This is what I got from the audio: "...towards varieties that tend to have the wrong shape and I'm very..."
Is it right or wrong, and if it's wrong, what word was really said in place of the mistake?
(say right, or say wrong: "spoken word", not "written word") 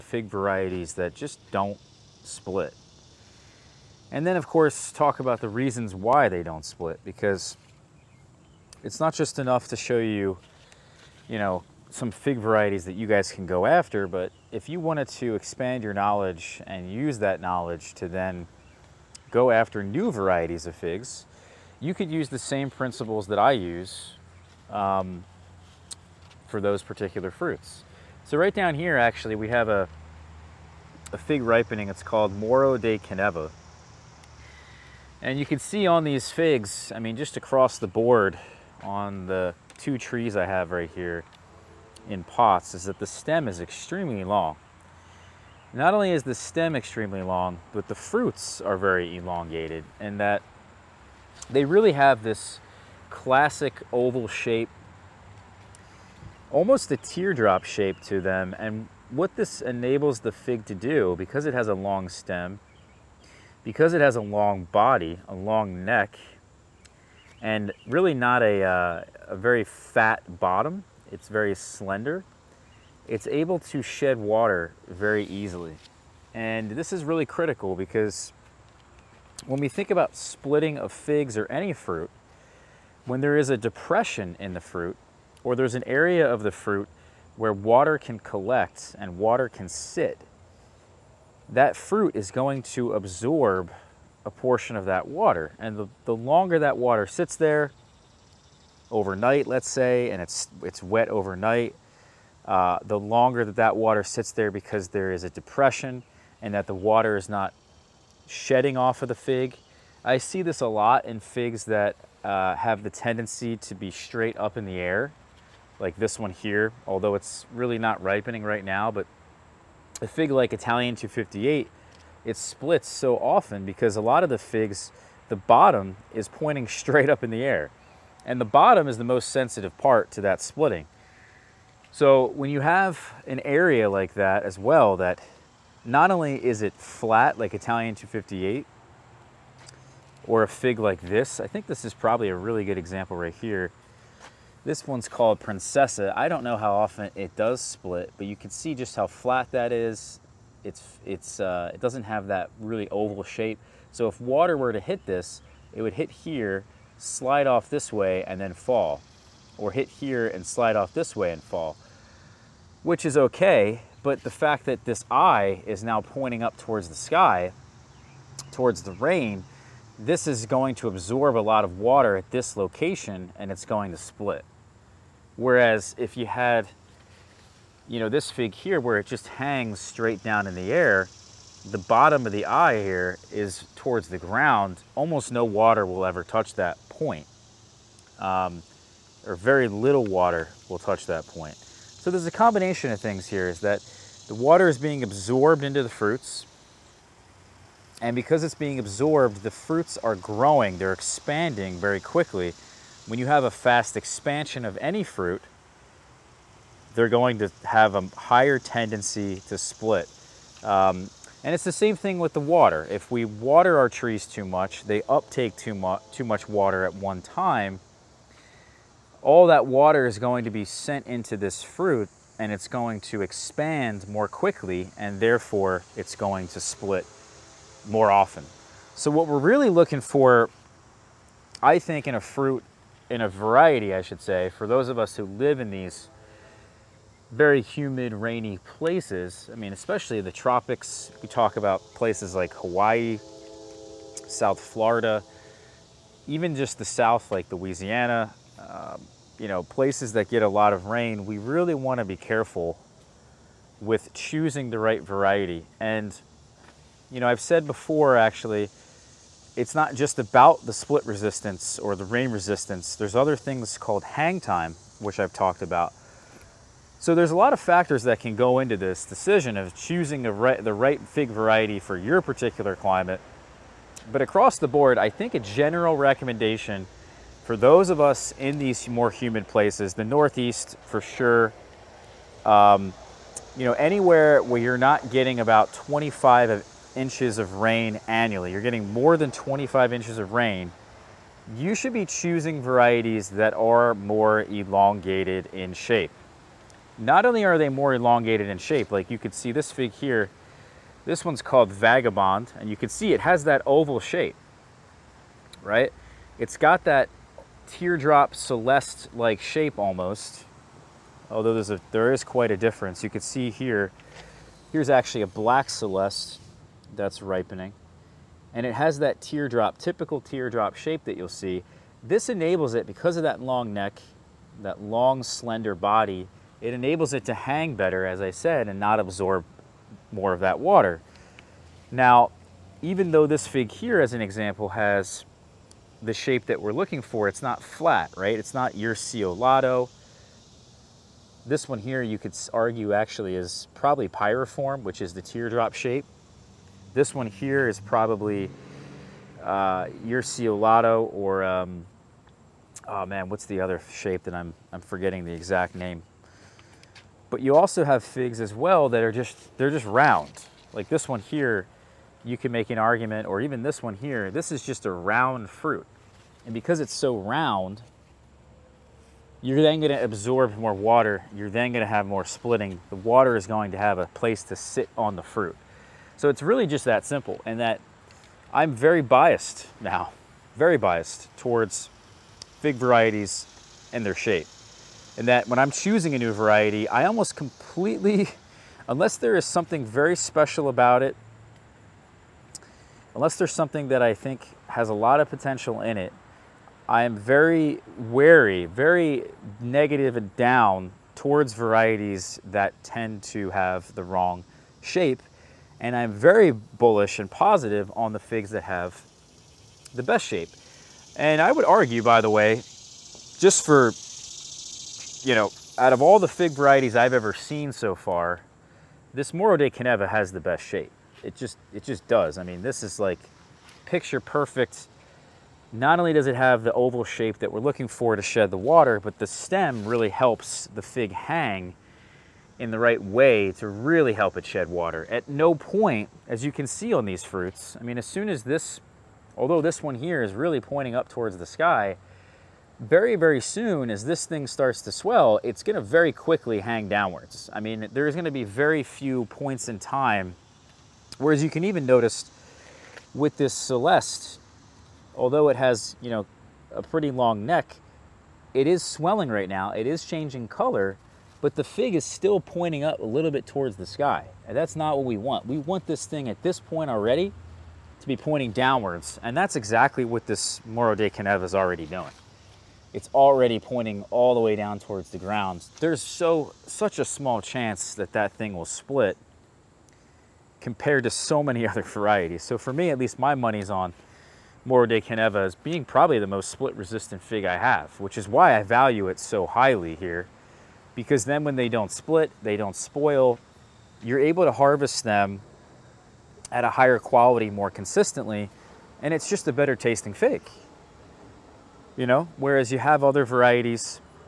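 right.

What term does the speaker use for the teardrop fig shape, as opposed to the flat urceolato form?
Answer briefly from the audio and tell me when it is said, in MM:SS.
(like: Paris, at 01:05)
Pyriform, at 05:44.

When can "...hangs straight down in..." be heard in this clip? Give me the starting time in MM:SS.
02:59.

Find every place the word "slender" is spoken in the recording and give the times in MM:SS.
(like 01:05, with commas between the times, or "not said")
01:11, 05:25.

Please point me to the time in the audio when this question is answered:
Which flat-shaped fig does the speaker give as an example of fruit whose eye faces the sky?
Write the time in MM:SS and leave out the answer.
02:25.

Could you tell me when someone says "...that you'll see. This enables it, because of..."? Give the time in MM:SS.
05:21.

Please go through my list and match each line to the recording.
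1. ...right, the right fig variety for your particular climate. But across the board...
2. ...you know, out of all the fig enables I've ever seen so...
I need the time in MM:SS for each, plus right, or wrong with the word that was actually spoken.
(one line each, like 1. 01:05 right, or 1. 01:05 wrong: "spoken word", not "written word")
1. 04:30 right
2. 06:55 wrong: "varieties", not "enables".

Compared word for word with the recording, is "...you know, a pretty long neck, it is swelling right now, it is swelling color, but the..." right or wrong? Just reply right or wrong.
wrong.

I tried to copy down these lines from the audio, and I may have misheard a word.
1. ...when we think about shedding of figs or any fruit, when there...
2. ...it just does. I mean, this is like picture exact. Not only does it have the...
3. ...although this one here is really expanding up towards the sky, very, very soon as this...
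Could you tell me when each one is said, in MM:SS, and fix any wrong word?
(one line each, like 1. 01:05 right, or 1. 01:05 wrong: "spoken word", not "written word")
1. 01:19 wrong: "splitting", not "shedding"
2. 07:01 wrong: "perfect", not "exact"
3. 07:19 wrong: "pointing", not "expanding".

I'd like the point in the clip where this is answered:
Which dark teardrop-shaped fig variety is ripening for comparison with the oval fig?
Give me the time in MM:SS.
05:15.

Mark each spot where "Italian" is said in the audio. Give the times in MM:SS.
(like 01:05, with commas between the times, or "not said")
02:00, 02:17.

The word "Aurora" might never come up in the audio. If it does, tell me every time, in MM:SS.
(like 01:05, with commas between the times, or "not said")
not said.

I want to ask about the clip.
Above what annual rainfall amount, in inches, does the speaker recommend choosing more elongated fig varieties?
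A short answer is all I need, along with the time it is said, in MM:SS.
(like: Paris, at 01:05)
25 inches, at 04:49.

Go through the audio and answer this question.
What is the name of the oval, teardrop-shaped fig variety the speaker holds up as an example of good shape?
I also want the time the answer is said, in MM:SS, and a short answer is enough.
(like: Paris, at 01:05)
Vagabond, at 05:01.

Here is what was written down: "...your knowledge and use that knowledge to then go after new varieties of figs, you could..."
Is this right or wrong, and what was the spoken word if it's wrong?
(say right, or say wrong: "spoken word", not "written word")
right.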